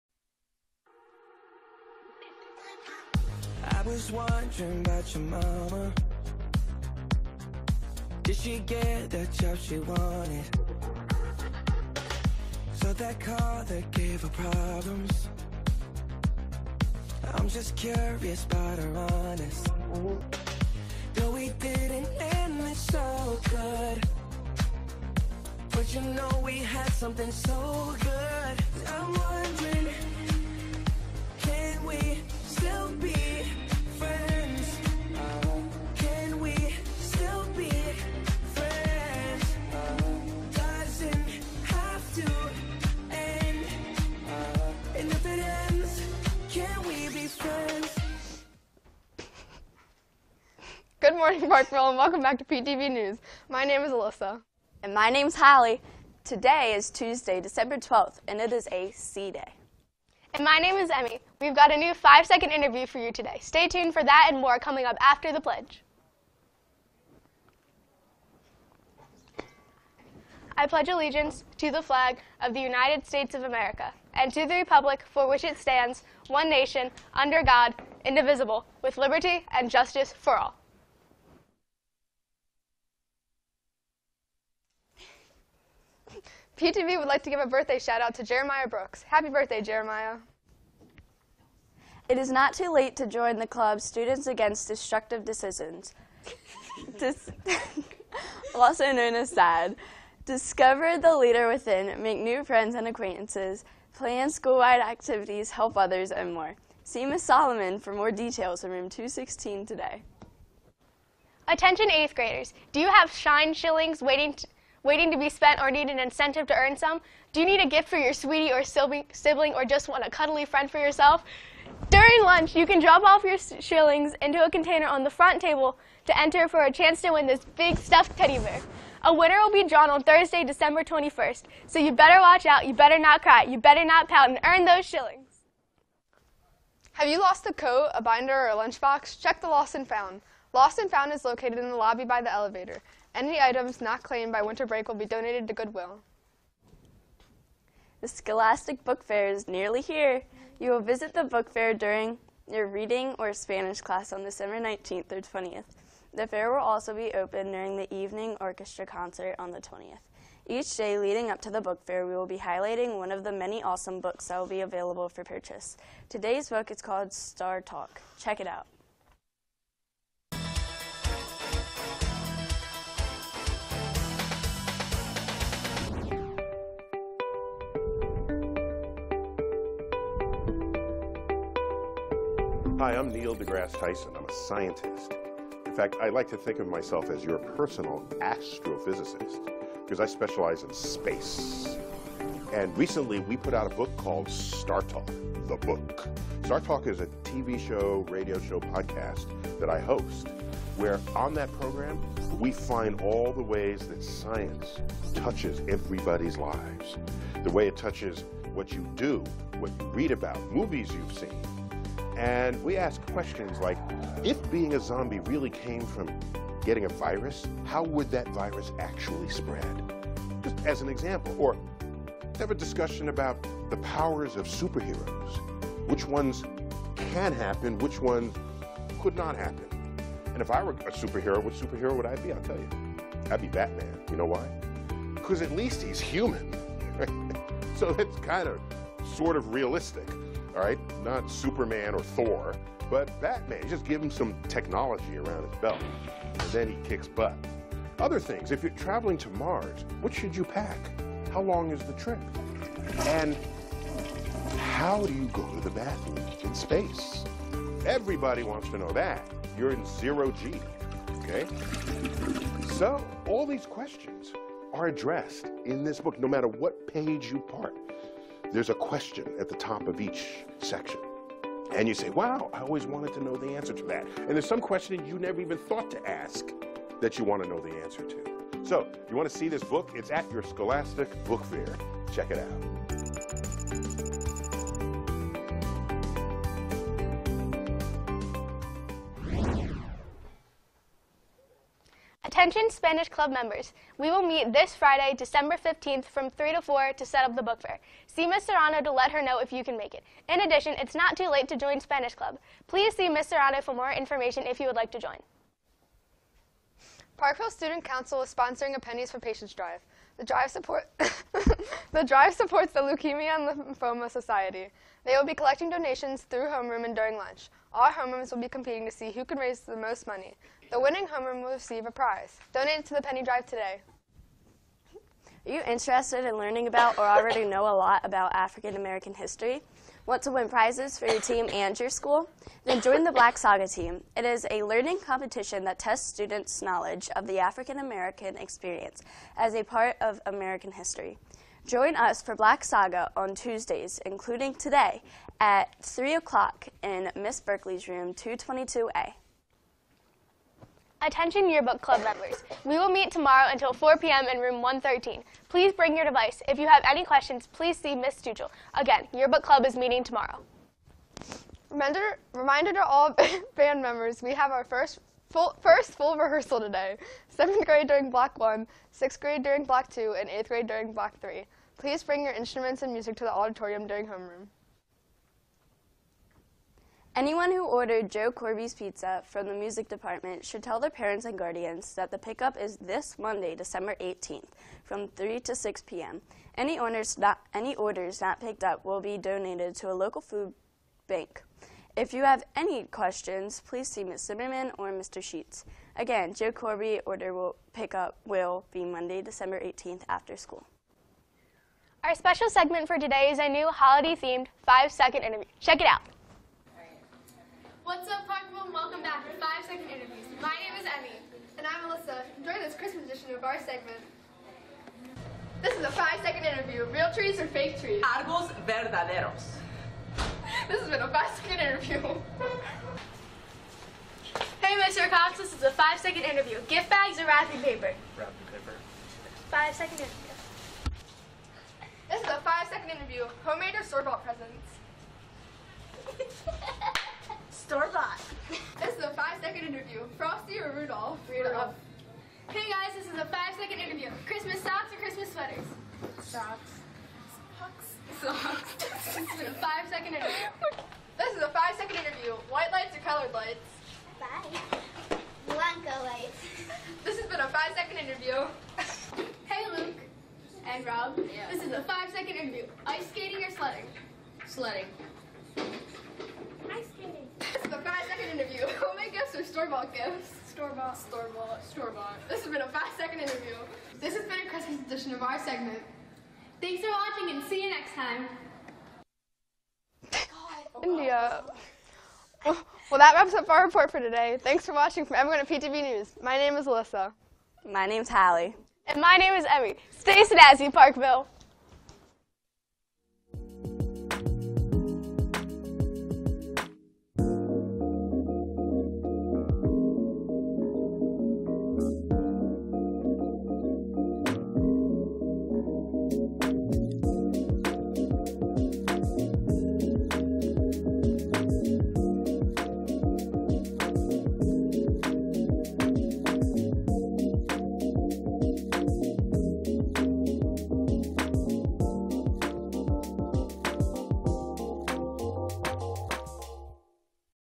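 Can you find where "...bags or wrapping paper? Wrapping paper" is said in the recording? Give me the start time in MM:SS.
07:06.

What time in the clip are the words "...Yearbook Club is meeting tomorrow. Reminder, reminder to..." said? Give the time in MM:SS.
05:59.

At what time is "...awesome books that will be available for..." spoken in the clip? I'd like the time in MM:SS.
02:43.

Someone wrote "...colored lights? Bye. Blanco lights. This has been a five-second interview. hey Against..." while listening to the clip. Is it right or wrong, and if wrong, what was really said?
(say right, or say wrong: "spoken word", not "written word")
wrong: "Luke", not "Against".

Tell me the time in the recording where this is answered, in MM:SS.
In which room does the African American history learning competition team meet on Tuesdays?
05:48.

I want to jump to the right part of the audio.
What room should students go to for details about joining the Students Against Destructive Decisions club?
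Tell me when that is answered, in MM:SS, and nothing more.
01:48.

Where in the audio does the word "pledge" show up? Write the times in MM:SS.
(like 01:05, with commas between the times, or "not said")
01:05, 01:10.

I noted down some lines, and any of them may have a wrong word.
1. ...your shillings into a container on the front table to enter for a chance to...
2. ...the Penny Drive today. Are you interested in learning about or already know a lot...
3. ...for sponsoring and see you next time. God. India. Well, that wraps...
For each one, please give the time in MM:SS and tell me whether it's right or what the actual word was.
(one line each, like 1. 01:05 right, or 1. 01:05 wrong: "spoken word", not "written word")
1. 02:03 right
2. 05:22 right
3. 07:56 wrong: "watching", not "sponsoring".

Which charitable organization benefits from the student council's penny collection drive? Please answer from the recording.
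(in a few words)
Leukemia and Lymphoma Society.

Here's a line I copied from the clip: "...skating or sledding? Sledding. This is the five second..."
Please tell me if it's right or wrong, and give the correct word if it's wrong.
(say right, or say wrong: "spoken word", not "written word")
right.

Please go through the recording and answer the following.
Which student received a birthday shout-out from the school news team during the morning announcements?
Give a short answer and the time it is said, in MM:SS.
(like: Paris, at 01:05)
Jeremiah Brooks, at 01:28.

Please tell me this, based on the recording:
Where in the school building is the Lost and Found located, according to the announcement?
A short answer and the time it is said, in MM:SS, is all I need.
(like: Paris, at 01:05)
lobby by the elevator, at 02:21.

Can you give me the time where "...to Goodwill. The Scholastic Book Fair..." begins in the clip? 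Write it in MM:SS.
02:25.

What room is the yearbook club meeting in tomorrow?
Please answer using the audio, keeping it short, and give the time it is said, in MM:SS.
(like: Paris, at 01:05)
113, at 05:54.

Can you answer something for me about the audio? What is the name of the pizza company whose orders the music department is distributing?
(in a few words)
Joe Corbi's.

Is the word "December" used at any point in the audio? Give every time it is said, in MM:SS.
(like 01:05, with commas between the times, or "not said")
00:57, 02:10, 02:34, 04:55, 06:23, 06:39.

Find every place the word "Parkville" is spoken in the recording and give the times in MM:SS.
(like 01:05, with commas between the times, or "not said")
00:51, 05:07, 06:48, 08:10.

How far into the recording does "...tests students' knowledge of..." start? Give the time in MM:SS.
05:35.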